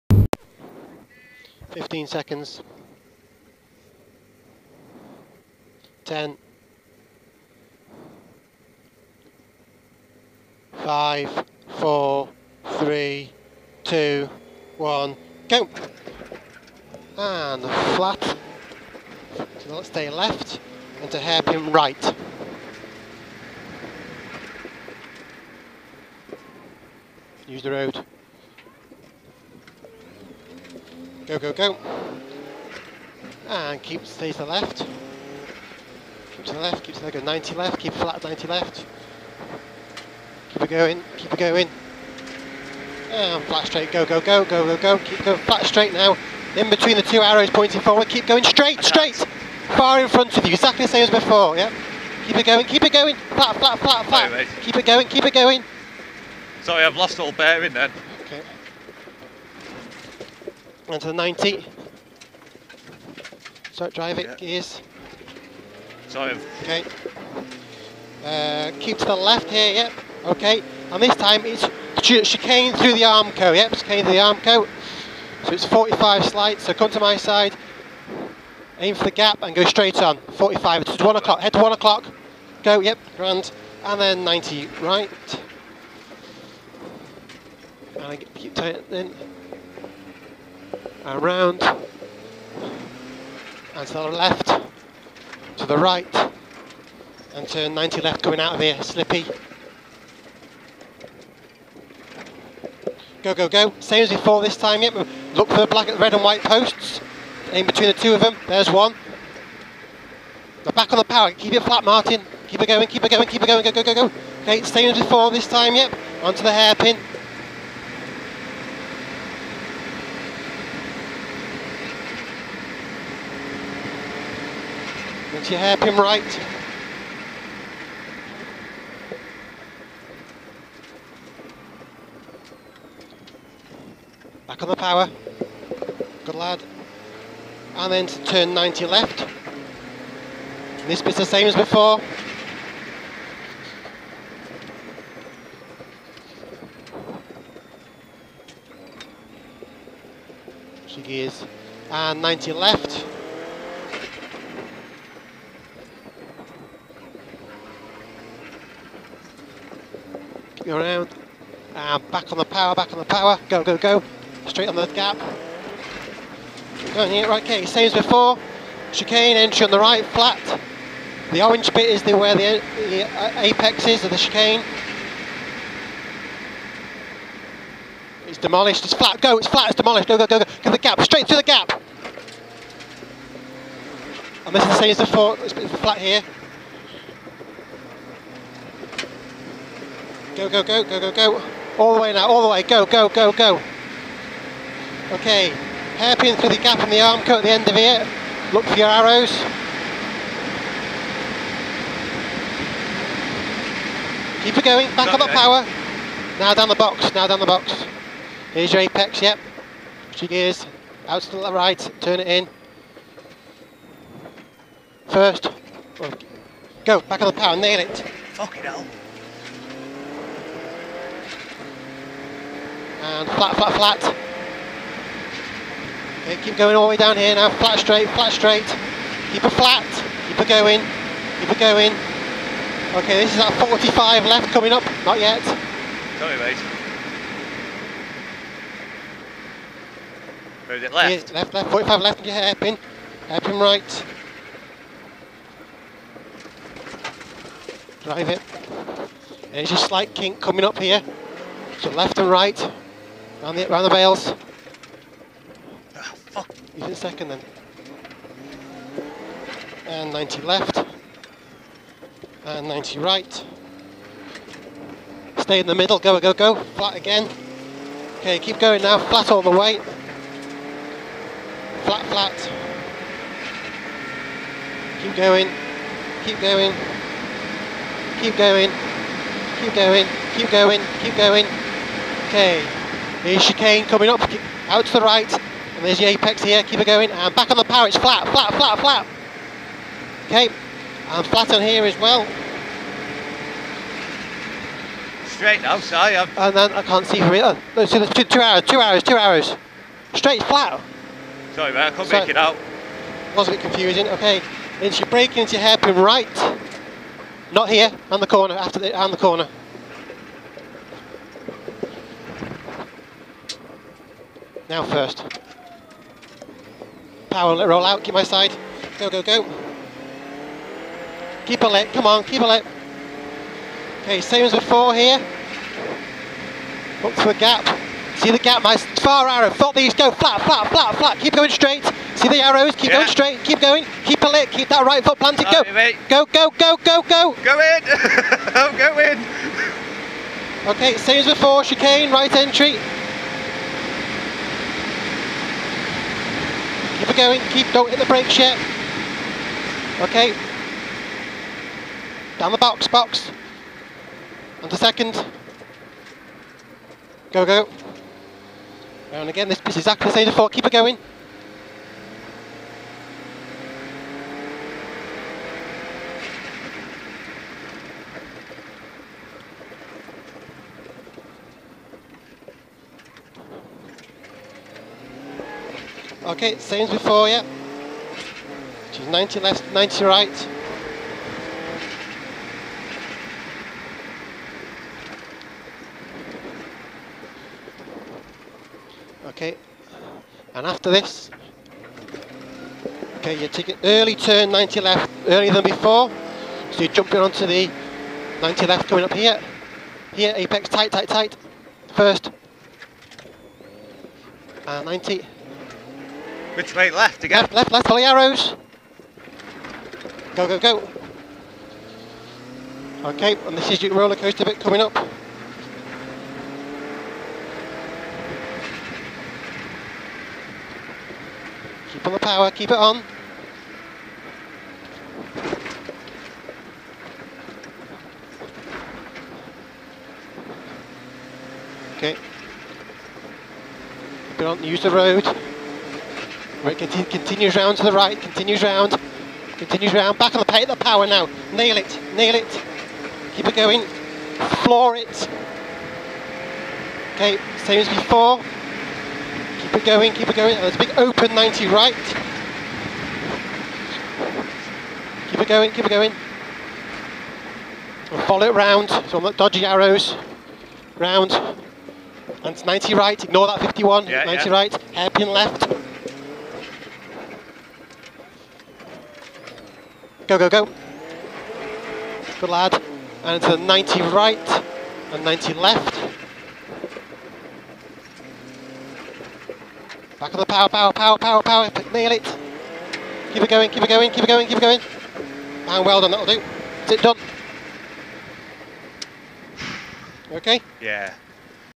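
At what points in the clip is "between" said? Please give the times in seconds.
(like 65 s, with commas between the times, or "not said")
46 s, 107 s.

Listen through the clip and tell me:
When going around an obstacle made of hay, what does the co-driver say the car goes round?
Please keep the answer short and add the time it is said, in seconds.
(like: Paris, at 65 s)
the bales, at 253 s.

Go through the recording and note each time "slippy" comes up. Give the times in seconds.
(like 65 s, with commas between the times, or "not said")
98 s.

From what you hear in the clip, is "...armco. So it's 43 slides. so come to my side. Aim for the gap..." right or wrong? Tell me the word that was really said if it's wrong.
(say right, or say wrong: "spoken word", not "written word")
wrong: "45", not "43".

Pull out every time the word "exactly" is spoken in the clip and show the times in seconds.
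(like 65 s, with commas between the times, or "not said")
50 s, 359 s.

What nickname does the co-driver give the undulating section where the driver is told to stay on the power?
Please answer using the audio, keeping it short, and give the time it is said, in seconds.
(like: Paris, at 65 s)
roller coaster bit, at 413 s.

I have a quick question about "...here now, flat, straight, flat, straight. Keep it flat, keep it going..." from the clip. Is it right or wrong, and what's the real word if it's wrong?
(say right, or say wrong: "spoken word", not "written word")
right.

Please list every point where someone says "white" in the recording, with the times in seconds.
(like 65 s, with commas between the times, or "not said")
106 s.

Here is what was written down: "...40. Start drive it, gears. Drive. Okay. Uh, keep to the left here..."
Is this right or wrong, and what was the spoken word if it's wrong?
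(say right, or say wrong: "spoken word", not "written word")
wrong: "90", not "40".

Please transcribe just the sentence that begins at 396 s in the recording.
So you're jumping onto the 90 left coming up here.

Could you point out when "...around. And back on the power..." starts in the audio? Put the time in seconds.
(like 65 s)
160 s.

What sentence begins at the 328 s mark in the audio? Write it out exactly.
See the gap, my far arrow, thought these, go flat, flat, flat, flat, keep going straight.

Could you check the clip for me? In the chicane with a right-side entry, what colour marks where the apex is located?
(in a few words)
orange.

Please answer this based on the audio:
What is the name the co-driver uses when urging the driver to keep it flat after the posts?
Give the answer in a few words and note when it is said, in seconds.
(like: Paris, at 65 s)
Martin, at 111 s.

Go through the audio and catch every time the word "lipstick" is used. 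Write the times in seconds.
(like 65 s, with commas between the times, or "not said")
not said.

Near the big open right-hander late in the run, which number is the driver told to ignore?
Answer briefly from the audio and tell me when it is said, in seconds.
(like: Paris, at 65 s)
51, at 463 s.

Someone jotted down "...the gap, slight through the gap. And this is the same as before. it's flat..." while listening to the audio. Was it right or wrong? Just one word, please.
wrong.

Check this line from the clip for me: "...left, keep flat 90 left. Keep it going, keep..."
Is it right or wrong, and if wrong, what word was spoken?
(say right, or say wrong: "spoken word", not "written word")
right.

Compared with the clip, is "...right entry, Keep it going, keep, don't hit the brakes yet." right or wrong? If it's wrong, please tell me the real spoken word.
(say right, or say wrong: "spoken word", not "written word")
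right.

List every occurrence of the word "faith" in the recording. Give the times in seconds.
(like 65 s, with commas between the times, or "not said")
not said.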